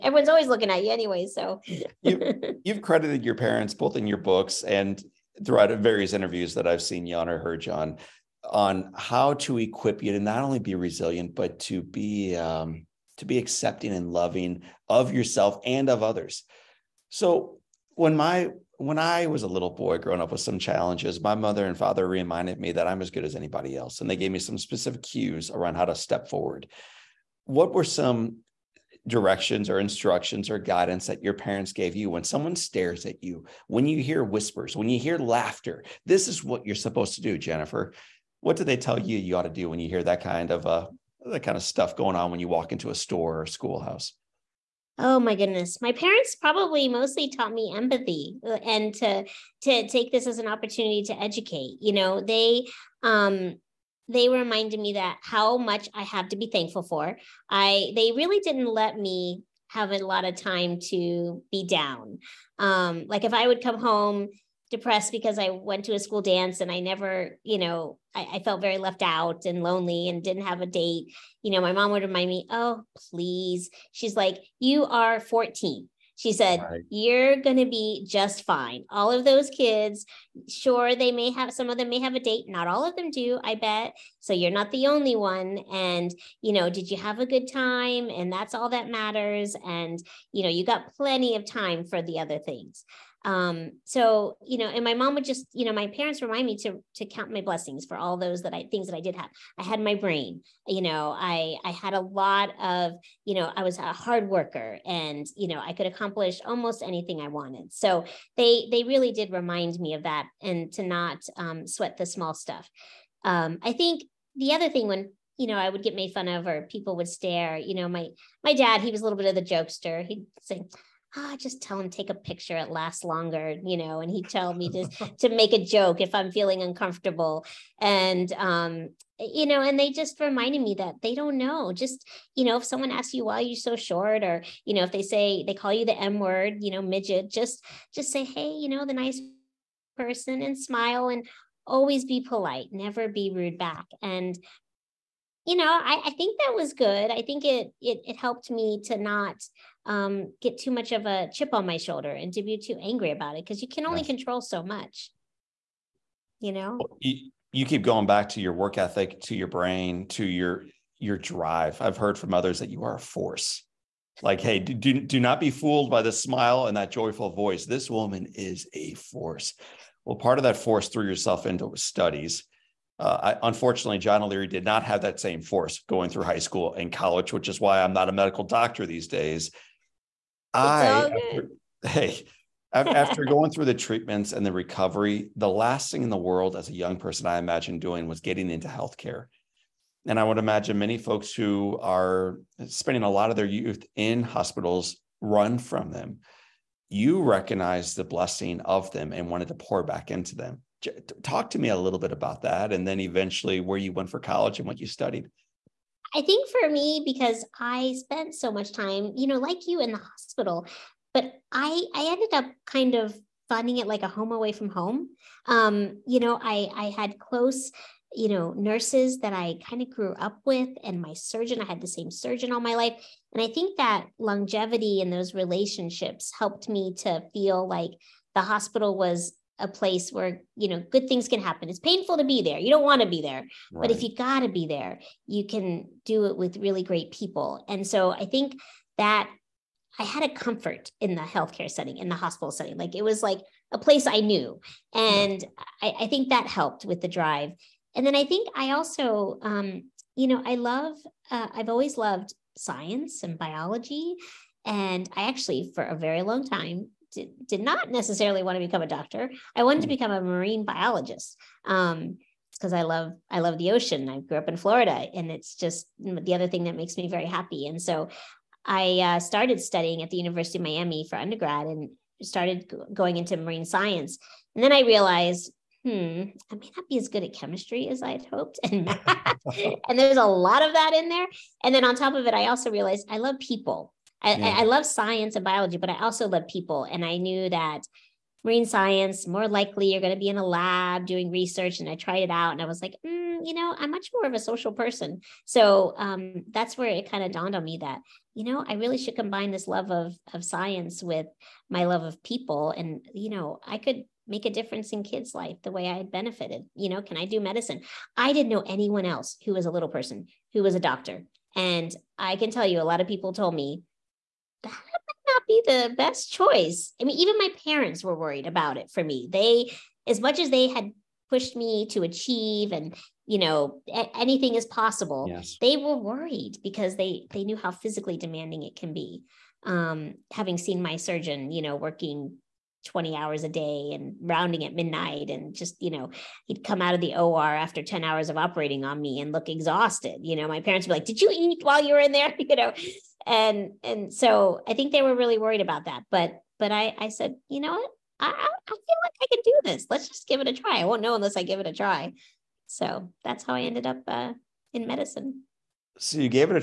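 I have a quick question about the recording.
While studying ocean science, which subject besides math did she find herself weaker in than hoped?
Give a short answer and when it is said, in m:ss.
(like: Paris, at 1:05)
Chemistry, at 4:37.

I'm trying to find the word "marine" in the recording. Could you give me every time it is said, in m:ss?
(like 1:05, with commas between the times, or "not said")
4:20, 4:33, 4:48.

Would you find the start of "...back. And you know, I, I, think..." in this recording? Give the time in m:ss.
2:23.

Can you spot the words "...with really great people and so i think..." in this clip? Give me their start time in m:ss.
3:56.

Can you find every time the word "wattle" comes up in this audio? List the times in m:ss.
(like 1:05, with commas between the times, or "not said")
not said.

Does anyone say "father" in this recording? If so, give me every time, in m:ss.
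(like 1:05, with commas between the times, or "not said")
0:21.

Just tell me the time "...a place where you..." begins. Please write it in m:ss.
3:49.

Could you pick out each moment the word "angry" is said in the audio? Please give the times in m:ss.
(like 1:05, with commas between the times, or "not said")
2:32.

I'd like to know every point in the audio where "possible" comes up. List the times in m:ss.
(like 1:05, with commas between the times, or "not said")
5:24.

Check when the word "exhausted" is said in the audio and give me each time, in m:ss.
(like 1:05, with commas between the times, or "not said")
5:39.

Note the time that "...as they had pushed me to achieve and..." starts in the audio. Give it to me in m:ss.
5:20.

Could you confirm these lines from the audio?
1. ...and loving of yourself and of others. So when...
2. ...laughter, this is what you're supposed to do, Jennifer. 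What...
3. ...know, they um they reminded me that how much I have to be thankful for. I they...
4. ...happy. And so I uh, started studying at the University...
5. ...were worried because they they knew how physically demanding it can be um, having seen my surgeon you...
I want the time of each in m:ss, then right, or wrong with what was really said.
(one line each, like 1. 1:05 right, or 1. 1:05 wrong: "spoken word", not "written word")
1. 0:13 right
2. 0:35 right
3. 0:51 right
4. 4:27 right
5. 5:25 right.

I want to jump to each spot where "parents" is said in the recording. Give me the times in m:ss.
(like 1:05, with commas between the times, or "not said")
0:03, 0:31, 0:45, 1:35, 5:17, 5:40.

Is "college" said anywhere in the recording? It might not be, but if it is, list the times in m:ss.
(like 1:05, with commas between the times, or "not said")
2:56, 3:24.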